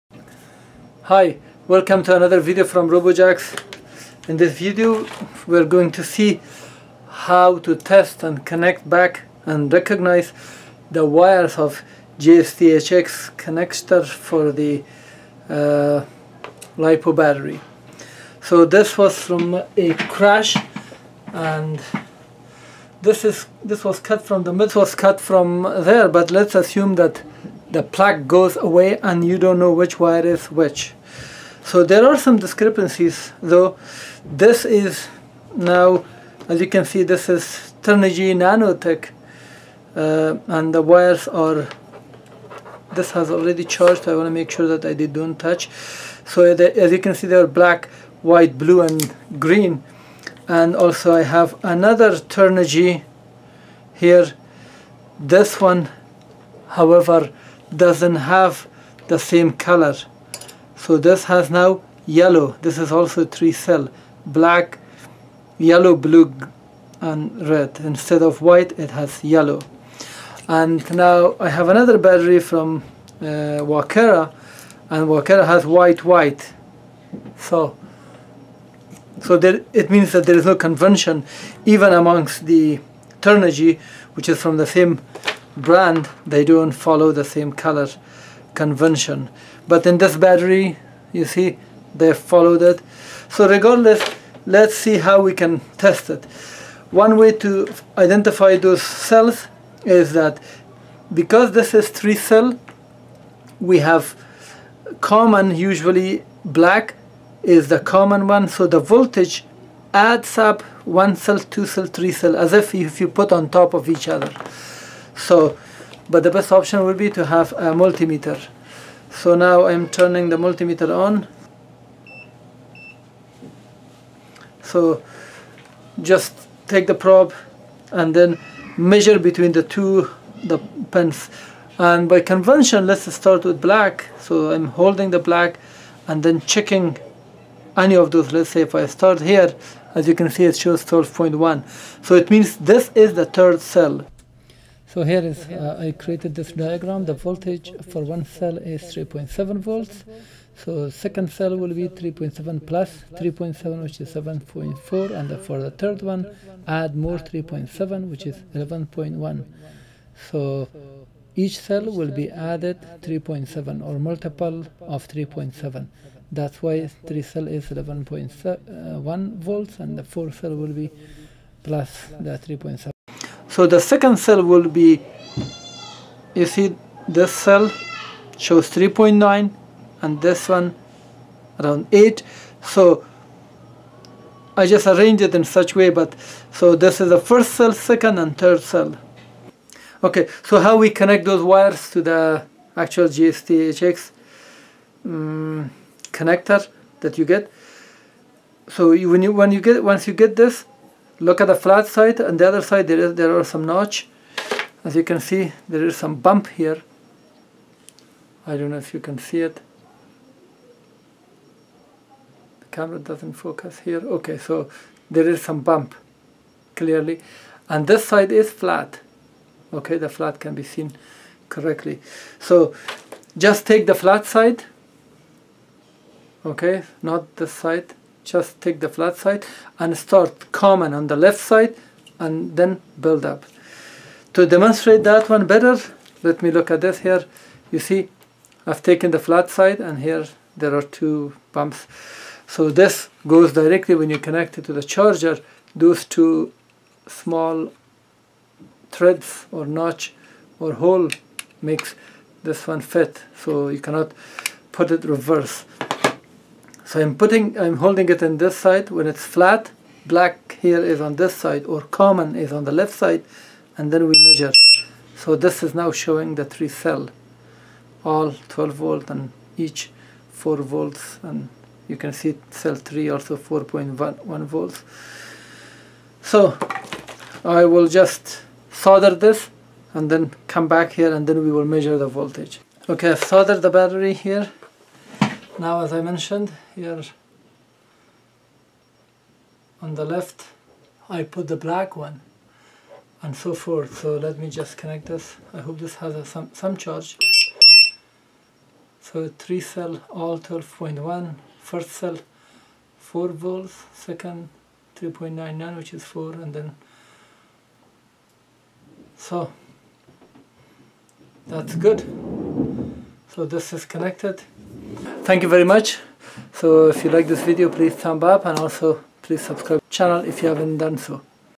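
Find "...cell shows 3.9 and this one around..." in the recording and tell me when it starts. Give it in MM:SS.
02:57.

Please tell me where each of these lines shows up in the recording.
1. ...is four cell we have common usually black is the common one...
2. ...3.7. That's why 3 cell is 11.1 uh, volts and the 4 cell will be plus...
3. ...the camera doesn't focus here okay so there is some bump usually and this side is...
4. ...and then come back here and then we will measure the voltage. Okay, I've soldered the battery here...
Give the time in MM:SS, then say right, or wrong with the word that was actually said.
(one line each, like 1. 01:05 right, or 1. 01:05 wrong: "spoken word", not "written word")
1. 01:41 wrong: "three", not "four"
2. 02:45 right
3. 03:32 wrong: "clearly", not "usually"
4. 04:39 right.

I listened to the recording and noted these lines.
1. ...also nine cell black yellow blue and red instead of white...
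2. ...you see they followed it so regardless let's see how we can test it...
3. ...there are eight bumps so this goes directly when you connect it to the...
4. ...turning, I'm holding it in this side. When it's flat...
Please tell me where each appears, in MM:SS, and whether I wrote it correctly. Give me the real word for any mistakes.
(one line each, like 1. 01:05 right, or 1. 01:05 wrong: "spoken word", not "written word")
1. 01:02 wrong: "three", not "nine"
2. 01:31 right
3. 04:00 wrong: "two", not "eight"
4. 04:17 wrong: "putting", not "turning".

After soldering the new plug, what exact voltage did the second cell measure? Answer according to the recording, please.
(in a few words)
3.99.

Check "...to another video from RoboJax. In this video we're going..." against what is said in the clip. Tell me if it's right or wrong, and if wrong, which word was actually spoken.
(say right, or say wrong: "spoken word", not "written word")
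right.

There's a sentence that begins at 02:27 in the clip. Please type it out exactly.
The voltage for one cell is 3.7 volts.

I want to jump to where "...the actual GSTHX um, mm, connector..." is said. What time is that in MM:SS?
03:12.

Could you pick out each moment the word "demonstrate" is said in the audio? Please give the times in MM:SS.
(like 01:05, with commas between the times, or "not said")
03:54.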